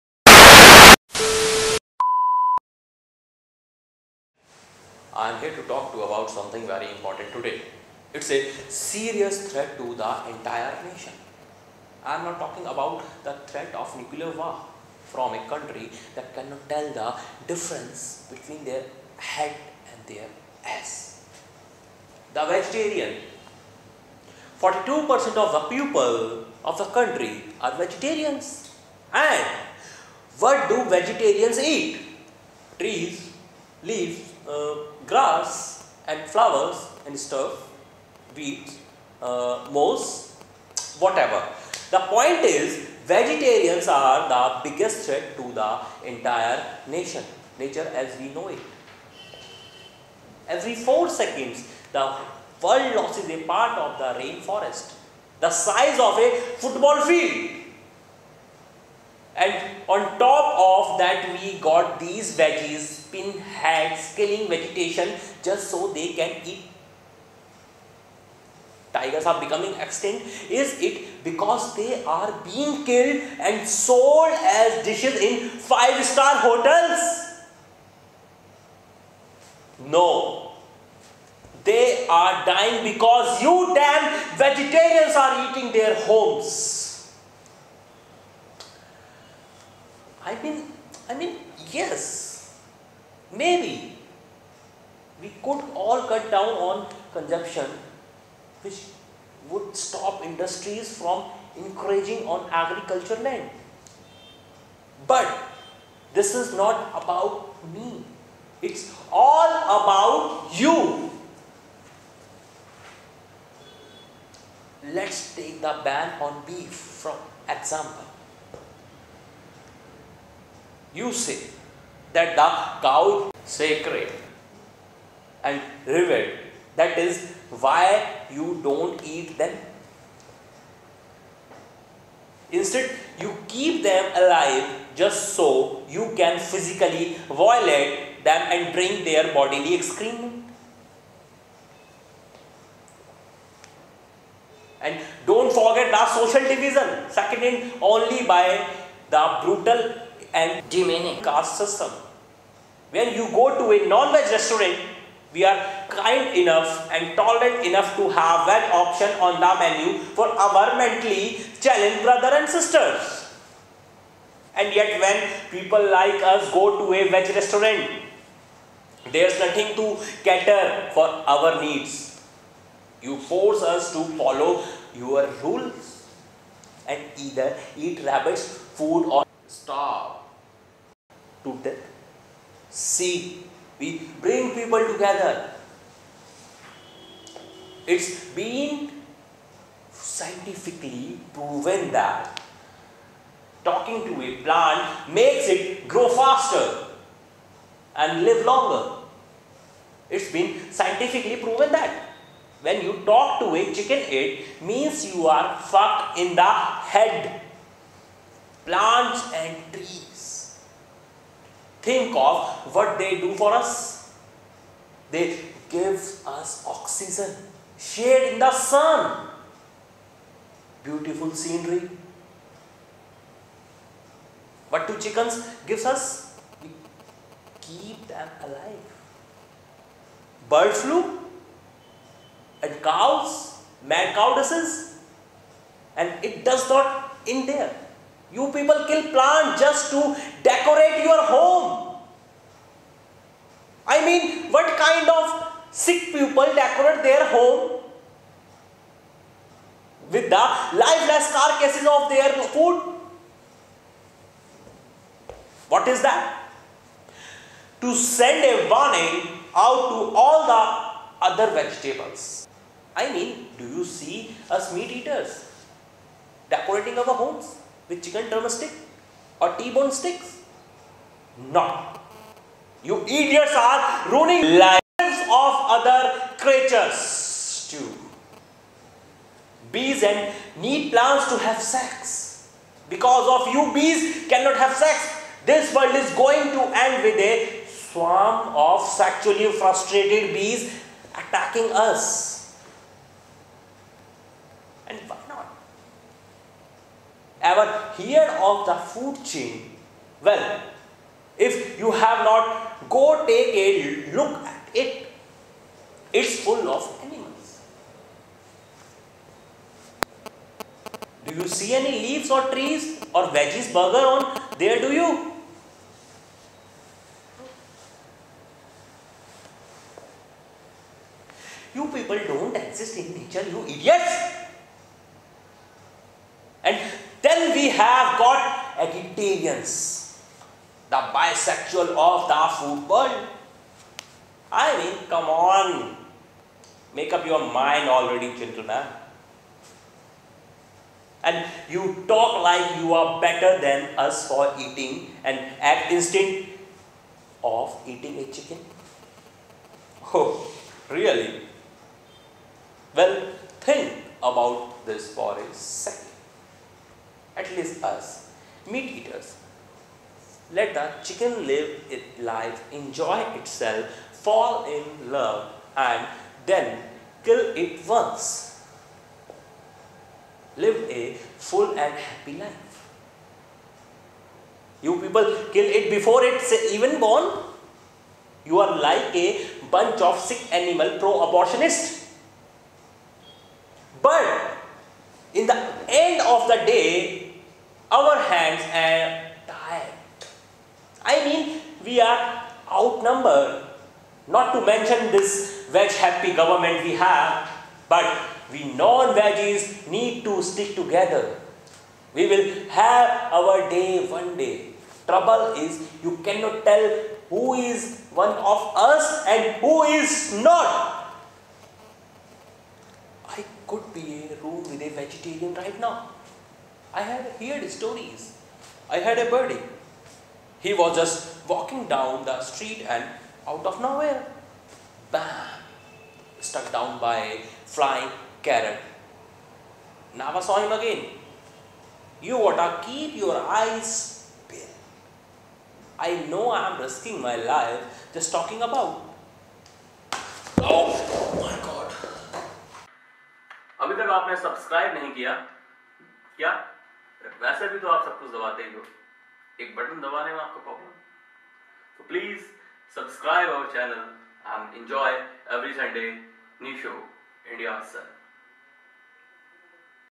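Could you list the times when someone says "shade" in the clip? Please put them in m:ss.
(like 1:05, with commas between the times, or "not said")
3:37.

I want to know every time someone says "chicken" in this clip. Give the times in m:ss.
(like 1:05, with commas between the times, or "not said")
3:23, 3:44, 4:28, 5:48, 6:01.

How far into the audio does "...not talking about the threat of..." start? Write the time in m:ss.
0:12.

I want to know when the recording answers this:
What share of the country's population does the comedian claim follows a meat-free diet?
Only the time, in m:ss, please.
0:24.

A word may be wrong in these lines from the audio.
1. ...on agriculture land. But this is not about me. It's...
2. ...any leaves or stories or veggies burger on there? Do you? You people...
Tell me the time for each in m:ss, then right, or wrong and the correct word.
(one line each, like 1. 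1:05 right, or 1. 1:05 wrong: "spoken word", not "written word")
1. 1:42 right
2. 5:11 wrong: "trees", not "stories".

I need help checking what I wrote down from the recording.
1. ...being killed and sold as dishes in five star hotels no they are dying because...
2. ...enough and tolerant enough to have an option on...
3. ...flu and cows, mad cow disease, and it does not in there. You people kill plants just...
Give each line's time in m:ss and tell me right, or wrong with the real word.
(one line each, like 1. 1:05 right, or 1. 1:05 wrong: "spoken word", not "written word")
1. 1:12 right
2. 2:36 right
3. 3:50 right.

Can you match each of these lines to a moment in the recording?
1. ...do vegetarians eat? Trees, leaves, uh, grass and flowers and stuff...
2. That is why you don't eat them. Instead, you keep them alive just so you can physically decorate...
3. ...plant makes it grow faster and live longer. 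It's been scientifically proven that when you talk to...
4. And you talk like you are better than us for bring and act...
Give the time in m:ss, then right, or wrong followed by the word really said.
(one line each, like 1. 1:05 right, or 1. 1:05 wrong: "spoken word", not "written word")
1. 0:30 right
2. 2:06 wrong: "violate", not "decorate"
3. 3:14 right
4. 5:41 wrong: "eating", not "bring".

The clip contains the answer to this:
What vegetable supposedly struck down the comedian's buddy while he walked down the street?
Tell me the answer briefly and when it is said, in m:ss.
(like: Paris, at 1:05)
Carrot, at 7:08.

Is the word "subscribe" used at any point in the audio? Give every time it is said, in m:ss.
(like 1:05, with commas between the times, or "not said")
7:32.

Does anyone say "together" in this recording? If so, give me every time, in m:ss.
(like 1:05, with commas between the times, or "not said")
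3:04, 6:40.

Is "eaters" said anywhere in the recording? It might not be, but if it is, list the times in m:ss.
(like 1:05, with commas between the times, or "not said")
4:24, 5:58.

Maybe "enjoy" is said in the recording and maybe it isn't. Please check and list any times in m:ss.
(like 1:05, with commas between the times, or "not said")
6:02, 7:34.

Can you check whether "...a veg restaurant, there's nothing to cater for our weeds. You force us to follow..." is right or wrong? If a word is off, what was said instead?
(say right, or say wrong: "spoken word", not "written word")
wrong: "needs", not "weeds".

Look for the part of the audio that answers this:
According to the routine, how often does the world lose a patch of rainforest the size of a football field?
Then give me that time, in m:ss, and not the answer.
0:50.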